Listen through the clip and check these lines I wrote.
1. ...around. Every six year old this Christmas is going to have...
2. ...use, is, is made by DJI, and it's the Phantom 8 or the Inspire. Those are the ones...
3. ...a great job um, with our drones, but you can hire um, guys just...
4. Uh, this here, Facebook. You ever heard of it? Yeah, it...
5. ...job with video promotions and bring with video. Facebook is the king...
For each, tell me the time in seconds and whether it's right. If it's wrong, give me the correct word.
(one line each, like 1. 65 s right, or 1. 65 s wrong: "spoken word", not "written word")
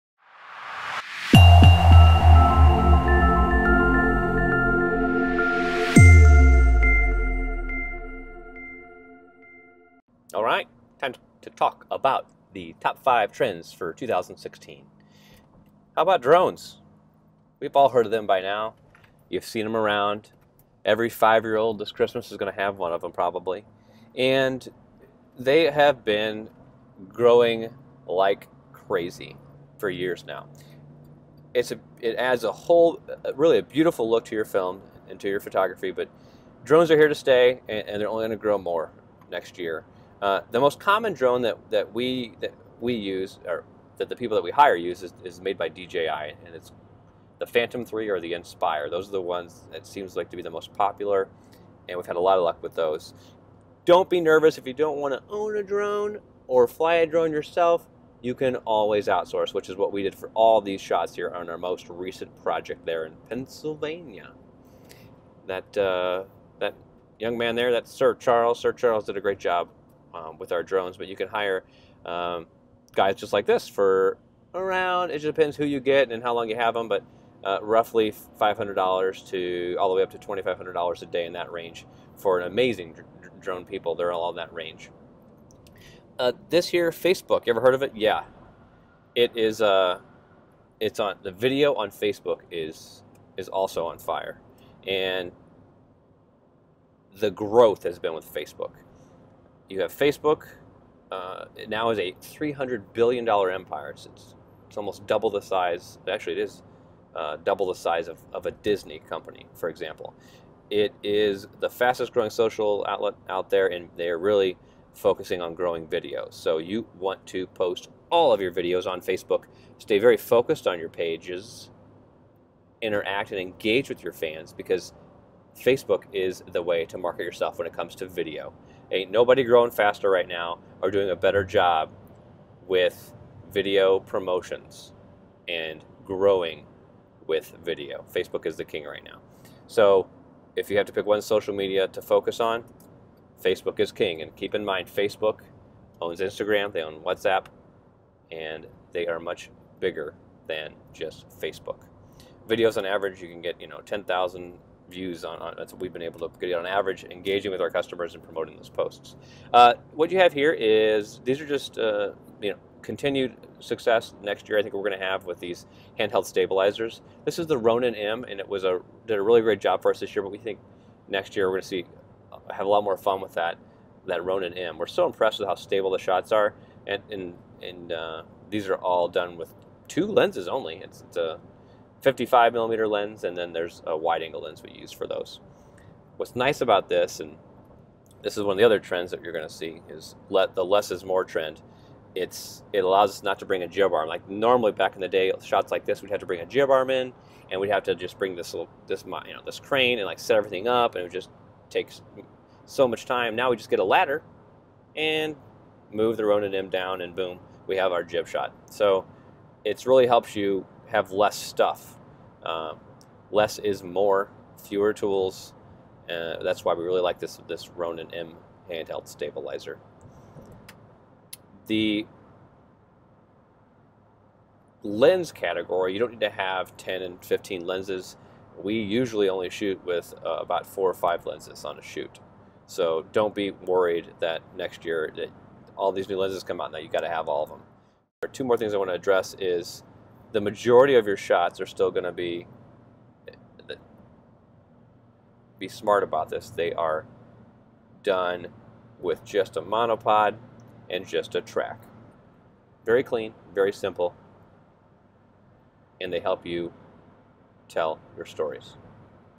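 1. 19 s wrong: "five", not "six"
2. 44 s wrong: "3", not "8"
3. 69 s right
4. 86 s right
5. 131 s wrong: "growing", not "bring".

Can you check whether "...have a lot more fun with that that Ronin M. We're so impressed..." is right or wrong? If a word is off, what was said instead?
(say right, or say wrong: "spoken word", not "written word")
right.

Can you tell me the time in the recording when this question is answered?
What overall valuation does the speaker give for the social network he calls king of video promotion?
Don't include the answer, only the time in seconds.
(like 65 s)
102 s.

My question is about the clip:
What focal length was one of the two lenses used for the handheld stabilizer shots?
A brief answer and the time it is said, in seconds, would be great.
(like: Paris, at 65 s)
55 millimeter, at 182 s.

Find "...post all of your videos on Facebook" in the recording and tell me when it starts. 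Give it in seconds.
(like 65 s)
117 s.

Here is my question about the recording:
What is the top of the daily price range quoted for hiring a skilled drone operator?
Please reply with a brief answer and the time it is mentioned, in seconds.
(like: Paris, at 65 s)
$2,500, at 80 s.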